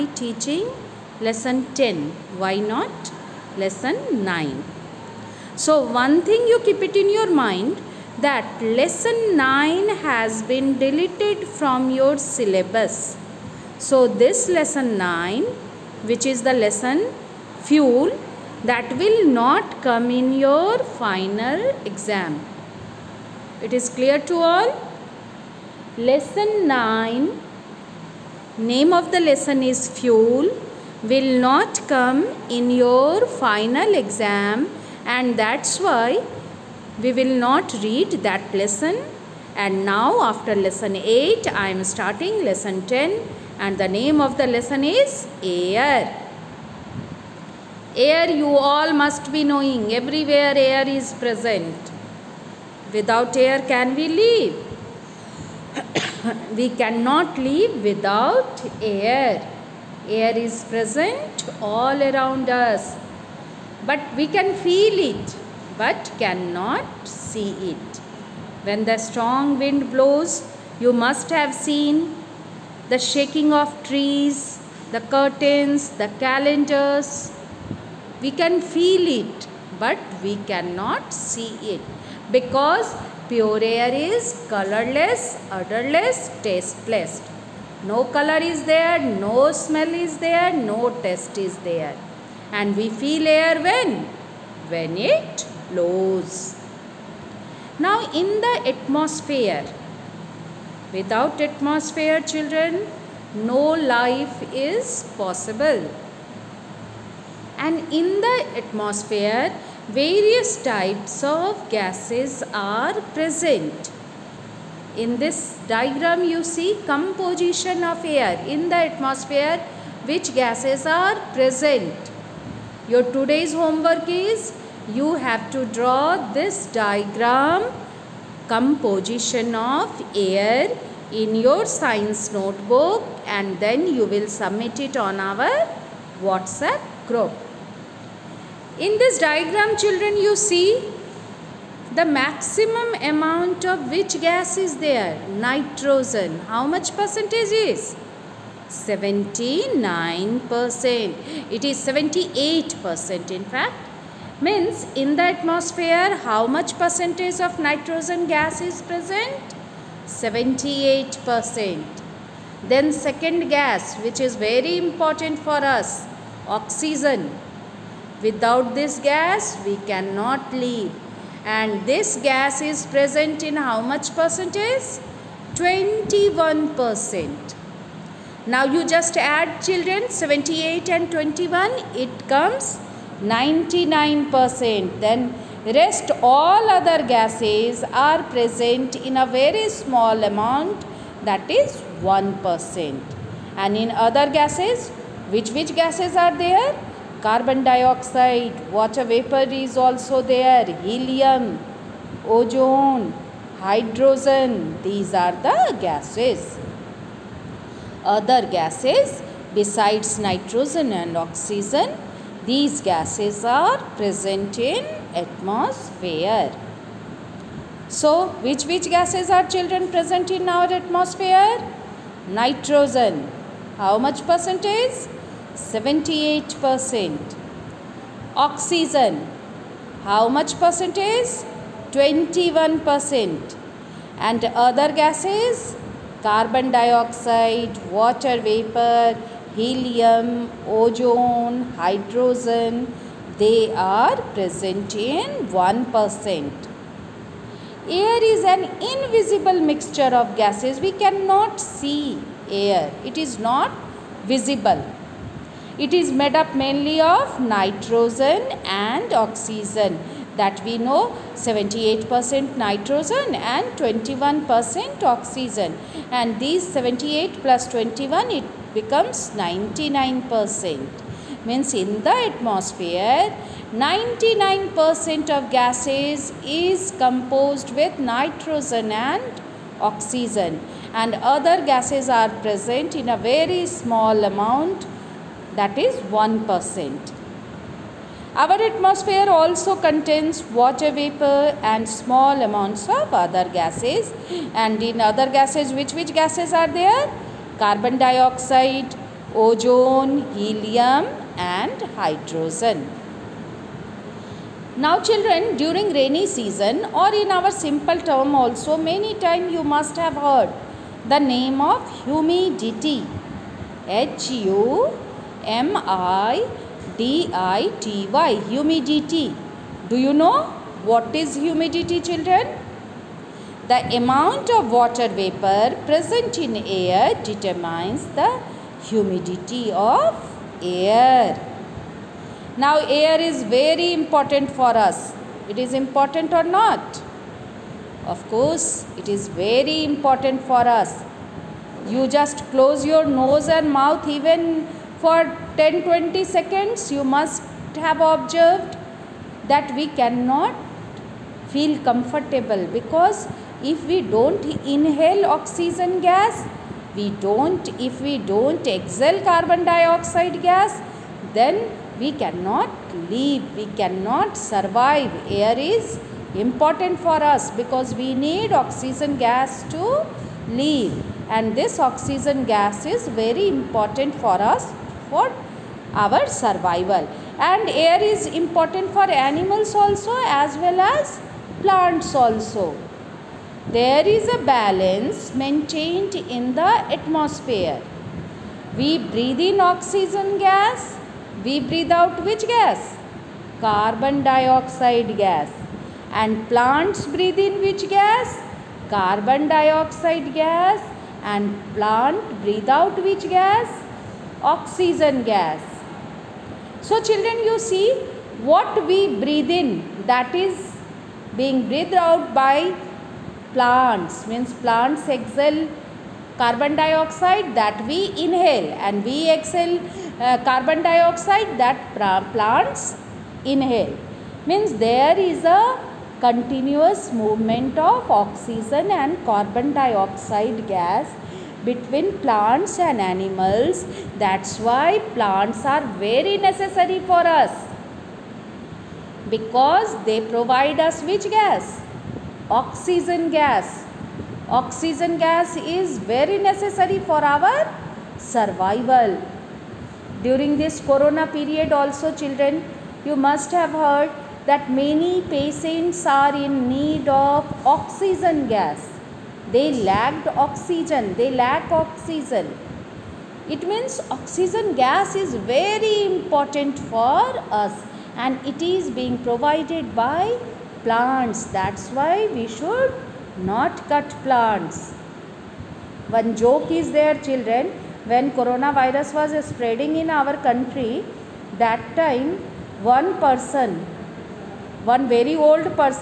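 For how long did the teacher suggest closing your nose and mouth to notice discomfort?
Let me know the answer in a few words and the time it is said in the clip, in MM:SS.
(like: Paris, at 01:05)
10-20 seconds, at 05:45.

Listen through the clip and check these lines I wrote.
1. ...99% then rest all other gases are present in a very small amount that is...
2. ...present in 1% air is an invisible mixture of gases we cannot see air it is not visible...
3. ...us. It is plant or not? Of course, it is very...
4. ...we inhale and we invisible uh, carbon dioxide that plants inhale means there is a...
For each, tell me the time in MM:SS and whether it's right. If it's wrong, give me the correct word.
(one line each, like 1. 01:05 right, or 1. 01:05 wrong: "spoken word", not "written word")
1. 03:03 right
2. 04:04 right
3. 05:34 wrong: "important", not "plant"
4. 06:57 wrong: "exhale", not "invisible".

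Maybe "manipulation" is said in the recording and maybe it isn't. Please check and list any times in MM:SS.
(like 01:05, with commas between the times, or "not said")
not said.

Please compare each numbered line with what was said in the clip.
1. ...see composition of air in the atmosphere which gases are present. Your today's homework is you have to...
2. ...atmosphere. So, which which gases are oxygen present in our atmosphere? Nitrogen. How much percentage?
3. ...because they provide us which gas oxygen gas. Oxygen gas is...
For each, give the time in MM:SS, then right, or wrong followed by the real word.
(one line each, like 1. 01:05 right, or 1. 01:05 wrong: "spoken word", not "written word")
1. 01:56 right
2. 03:35 wrong: "children", not "oxygen"
3. 07:19 right.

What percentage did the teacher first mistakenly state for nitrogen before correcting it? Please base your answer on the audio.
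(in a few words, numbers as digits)
79%.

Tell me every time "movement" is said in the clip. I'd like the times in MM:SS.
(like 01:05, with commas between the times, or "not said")
07:07.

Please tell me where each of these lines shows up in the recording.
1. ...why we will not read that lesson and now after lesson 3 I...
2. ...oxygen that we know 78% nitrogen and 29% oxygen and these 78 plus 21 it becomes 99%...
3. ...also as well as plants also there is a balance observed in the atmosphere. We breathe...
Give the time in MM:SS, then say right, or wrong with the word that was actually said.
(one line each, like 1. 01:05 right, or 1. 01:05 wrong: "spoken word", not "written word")
1. 00:35 wrong: "8", not "3"
2. 04:19 wrong: "21", not "29"
3. 06:19 wrong: "maintained", not "observed".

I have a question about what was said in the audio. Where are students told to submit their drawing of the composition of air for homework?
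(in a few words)
WhatsApp group.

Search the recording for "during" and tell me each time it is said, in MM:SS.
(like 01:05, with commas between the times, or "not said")
05:05, 07:30.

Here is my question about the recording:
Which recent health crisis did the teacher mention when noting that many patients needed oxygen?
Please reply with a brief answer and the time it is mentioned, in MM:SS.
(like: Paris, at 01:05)
Corona, at 07:30.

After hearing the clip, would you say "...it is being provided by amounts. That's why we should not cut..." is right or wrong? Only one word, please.
wrong.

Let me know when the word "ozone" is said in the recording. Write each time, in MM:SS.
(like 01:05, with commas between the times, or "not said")
03:22, 04:00, 04:59.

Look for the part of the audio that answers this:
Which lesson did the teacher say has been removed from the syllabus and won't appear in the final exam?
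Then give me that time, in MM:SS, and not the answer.
00:08.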